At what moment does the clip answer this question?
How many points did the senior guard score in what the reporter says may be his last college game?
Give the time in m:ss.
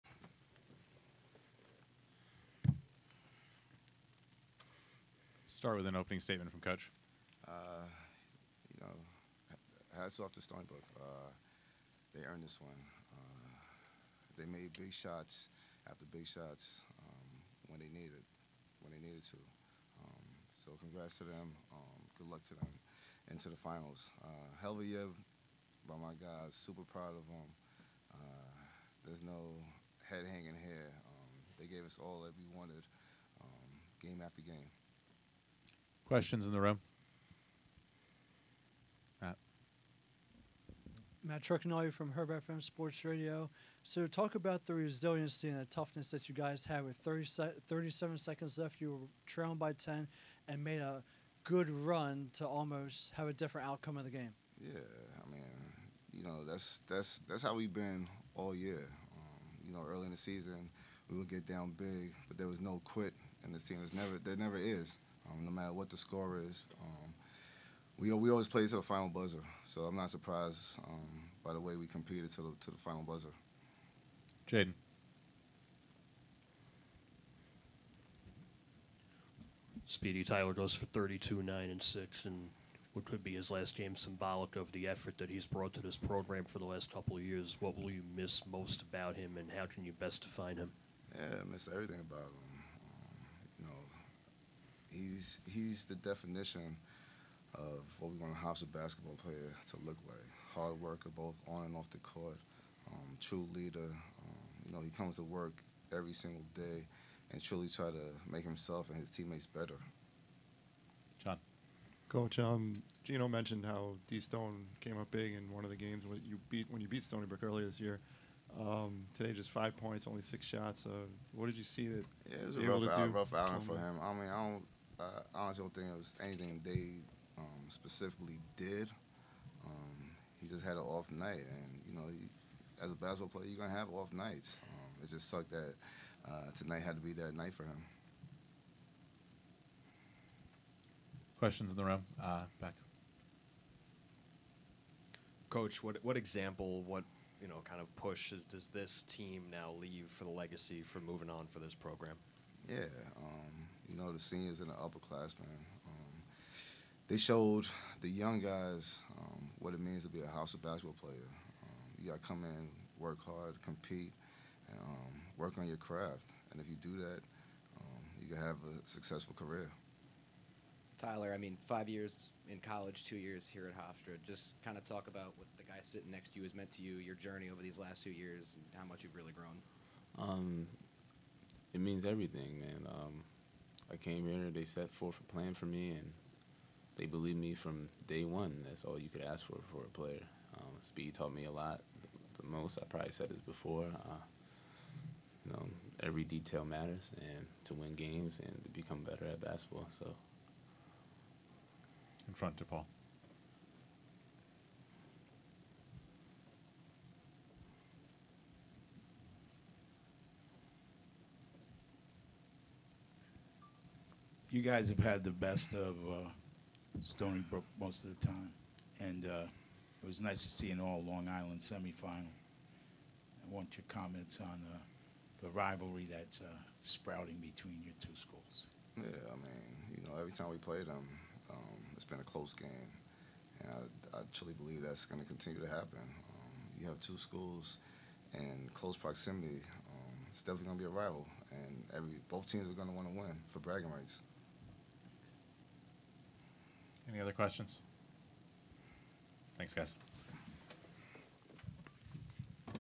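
1:20.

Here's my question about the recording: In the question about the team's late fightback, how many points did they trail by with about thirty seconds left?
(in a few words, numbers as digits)
10.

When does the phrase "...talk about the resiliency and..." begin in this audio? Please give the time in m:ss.
0:44.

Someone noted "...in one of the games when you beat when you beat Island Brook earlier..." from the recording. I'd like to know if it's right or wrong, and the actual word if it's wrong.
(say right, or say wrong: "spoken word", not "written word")
wrong: "Stony", not "Island".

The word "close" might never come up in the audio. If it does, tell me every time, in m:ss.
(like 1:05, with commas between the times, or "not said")
3:52, 3:58.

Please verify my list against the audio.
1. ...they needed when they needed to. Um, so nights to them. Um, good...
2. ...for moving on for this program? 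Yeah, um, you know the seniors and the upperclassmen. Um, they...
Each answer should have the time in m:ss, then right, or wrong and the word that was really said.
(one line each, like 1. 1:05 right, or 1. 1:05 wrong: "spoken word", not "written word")
1. 0:17 wrong: "congrats", not "nights"
2. 2:30 right.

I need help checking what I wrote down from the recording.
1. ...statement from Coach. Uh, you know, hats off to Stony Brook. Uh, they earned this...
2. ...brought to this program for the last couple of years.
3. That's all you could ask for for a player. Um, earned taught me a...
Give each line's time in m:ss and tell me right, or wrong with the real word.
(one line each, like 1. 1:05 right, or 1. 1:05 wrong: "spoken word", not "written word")
1. 0:06 right
2. 1:25 right
3. 3:08 wrong: "speed", not "earned".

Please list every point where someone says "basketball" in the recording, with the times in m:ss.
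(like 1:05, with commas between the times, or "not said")
1:38, 2:12, 2:40, 3:19.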